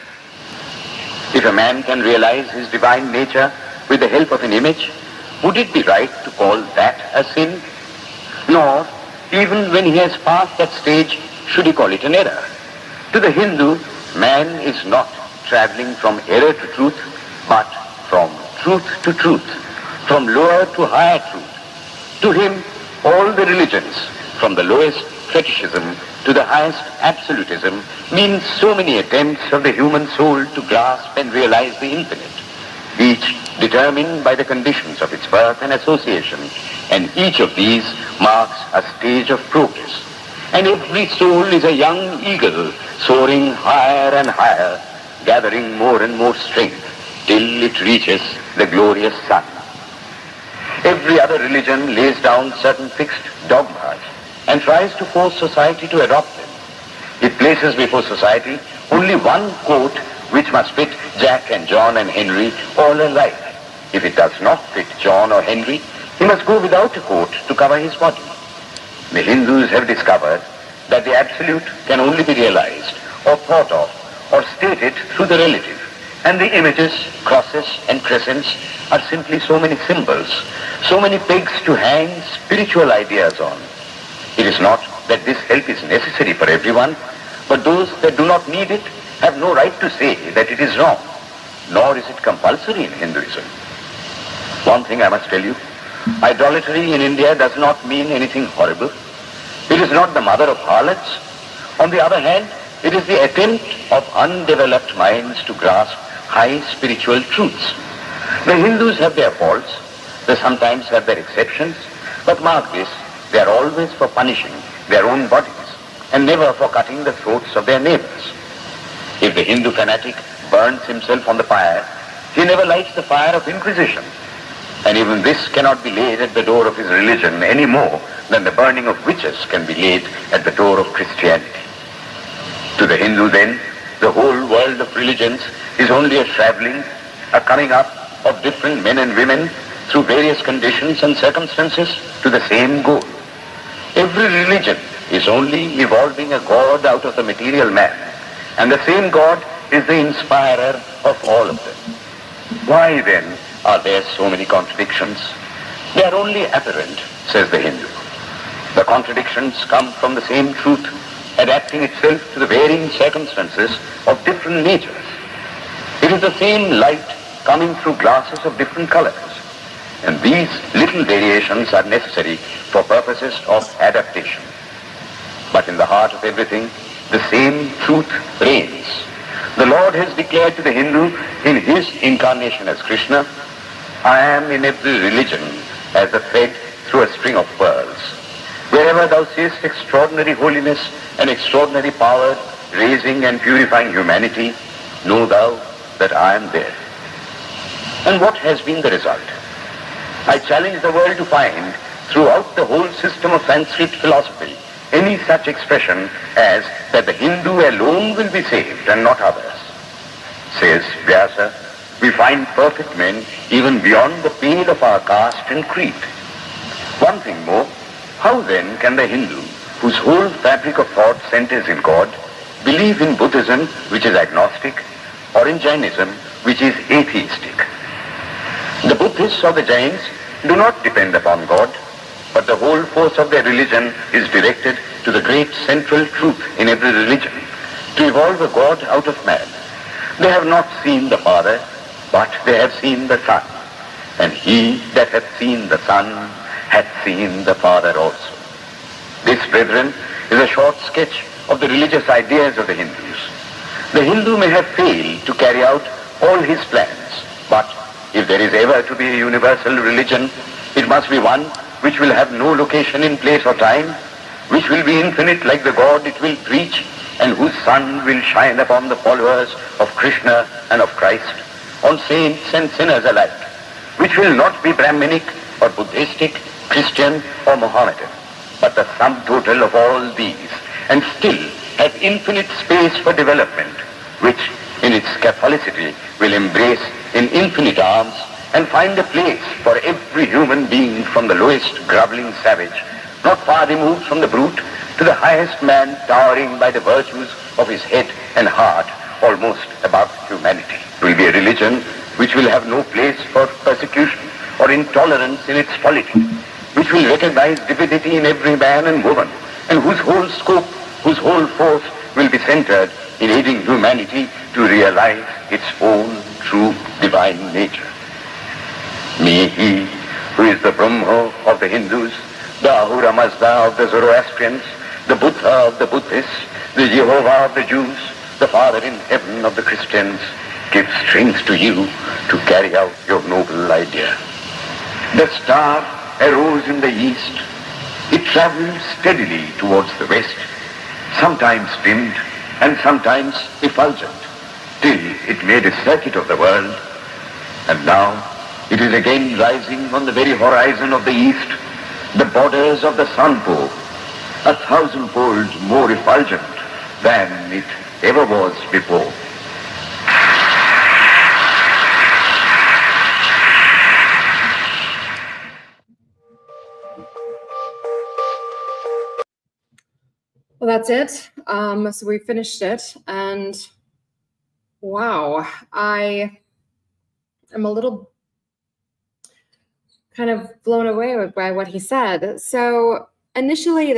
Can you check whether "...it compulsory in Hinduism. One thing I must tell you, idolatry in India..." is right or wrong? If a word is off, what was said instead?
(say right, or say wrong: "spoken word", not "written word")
right.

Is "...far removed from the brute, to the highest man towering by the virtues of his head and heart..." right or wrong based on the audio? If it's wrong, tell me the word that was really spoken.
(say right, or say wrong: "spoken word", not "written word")
right.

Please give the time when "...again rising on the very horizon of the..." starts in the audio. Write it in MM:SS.
05:48.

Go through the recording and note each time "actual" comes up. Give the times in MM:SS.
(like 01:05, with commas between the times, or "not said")
not said.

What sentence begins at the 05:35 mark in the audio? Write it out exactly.
The star arose in the east.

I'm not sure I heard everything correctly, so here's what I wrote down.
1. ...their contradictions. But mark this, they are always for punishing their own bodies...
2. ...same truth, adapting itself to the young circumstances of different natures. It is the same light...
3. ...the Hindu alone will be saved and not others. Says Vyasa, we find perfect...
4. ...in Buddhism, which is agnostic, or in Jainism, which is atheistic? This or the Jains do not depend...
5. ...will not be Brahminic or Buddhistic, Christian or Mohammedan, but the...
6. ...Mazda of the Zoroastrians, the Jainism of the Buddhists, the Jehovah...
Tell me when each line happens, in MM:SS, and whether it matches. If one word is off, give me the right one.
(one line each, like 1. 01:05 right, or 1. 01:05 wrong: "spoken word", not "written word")
1. 01:51 wrong: "exceptions", not "contradictions"
2. 02:40 wrong: "varying", not "young"
3. 03:27 right
4. 03:43 right
5. 04:34 right
6. 05:23 wrong: "Buddha", not "Jainism".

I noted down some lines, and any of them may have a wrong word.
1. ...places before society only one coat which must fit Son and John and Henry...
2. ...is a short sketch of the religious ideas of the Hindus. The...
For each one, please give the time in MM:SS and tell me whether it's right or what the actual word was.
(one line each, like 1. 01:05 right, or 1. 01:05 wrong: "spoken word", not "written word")
1. 00:57 wrong: "Jack", not "Son"
2. 04:10 right.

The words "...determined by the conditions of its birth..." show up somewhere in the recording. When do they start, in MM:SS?
00:33.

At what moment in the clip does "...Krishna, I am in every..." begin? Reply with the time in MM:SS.
03:02.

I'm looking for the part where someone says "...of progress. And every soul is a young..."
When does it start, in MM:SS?
00:39.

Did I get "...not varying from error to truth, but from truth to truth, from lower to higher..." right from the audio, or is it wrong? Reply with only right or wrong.
wrong.